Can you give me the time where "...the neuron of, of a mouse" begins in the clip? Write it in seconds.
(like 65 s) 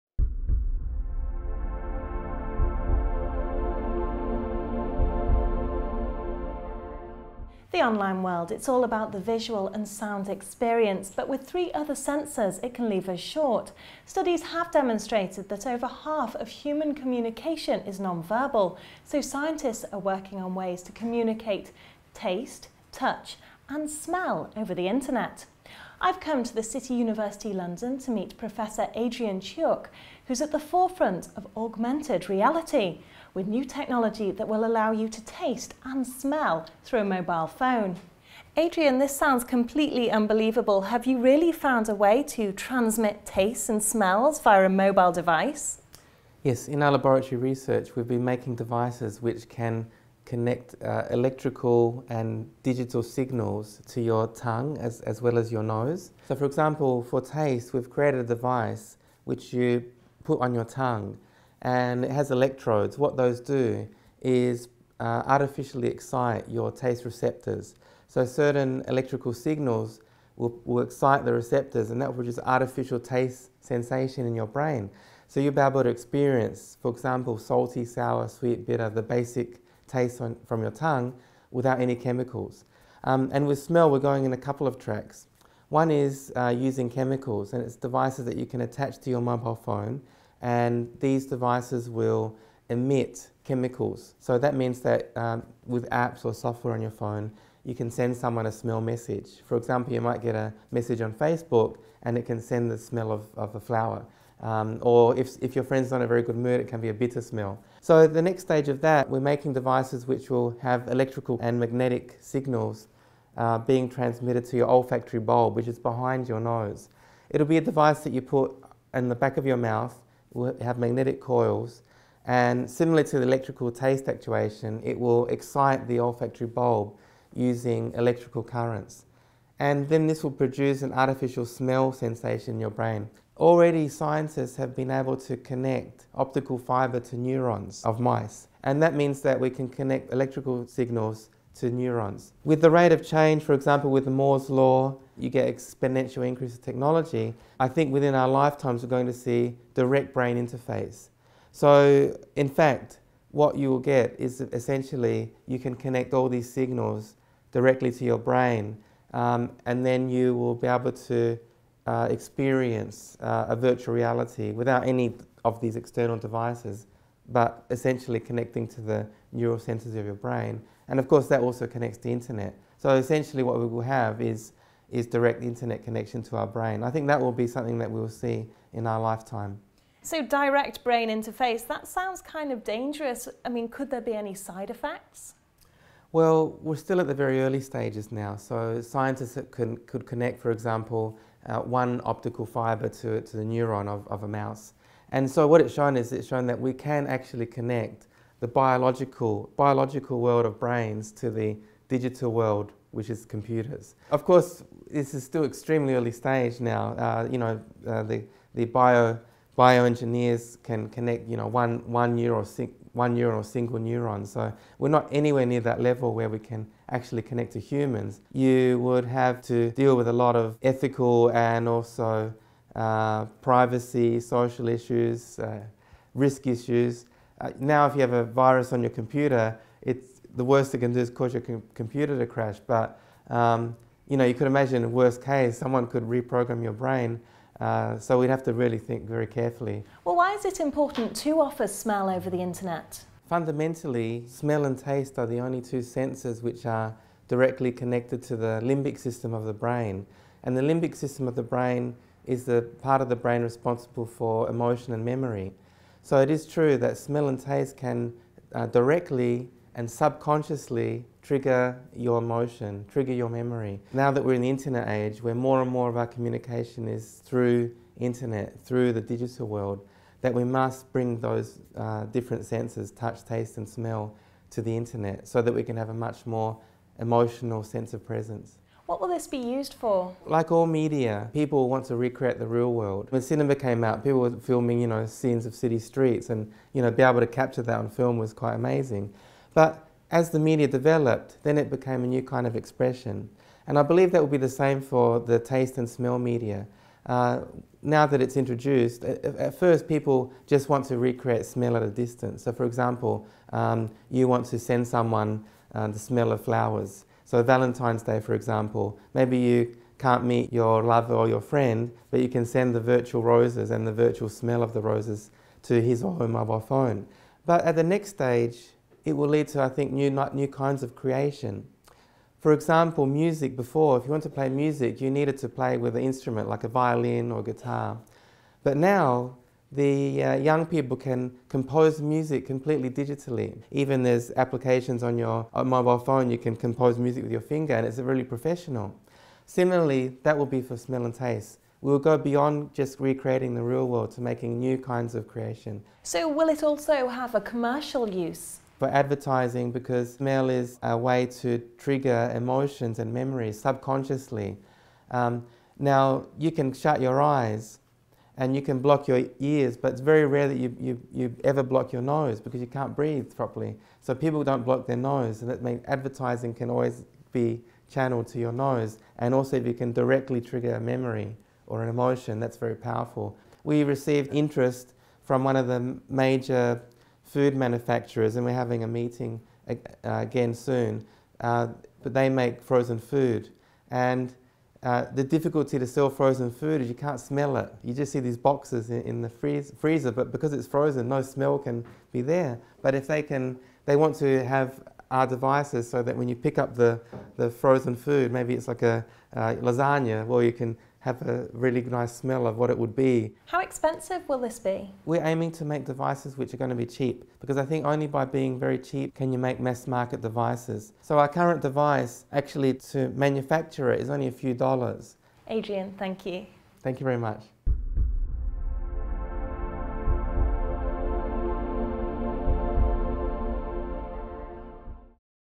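193 s.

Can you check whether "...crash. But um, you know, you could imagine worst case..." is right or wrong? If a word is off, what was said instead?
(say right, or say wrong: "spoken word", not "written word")
right.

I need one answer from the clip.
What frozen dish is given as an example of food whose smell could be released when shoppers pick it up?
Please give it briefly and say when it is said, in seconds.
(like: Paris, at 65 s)
Lasagna, at 399 s.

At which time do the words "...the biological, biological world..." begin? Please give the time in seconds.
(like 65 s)
198 s.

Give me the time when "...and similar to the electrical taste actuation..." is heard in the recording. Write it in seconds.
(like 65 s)
122 s.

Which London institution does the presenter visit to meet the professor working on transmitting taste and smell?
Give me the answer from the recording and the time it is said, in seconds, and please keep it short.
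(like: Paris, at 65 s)
City University London, at 26 s.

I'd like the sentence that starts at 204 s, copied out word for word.
Of course, this is still extremely early stage now.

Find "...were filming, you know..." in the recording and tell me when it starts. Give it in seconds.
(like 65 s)
284 s.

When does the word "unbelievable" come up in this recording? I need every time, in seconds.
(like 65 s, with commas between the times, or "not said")
40 s.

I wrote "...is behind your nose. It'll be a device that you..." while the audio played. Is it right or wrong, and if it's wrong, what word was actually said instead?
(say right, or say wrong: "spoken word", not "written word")
right.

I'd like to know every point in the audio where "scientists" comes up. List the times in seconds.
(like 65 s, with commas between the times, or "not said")
19 s, 133 s, 188 s.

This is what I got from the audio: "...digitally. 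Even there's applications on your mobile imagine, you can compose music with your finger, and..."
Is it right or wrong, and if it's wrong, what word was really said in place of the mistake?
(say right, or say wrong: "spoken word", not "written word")
wrong: "phone", not "imagine".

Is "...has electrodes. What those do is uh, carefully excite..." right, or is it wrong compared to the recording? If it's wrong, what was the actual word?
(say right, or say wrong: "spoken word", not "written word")
wrong: "artificially", not "carefully".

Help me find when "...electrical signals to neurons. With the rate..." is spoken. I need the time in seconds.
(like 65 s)
140 s.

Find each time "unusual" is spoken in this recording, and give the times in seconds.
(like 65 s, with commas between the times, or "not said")
not said.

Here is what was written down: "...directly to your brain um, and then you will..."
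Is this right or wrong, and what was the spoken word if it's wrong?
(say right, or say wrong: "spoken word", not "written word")
right.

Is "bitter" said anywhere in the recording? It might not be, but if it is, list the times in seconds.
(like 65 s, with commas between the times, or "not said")
78 s, 106 s.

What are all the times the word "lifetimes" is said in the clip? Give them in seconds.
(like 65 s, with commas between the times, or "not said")
148 s, 178 s.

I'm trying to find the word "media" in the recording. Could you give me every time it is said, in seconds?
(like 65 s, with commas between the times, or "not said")
280 s, 290 s, 296 s.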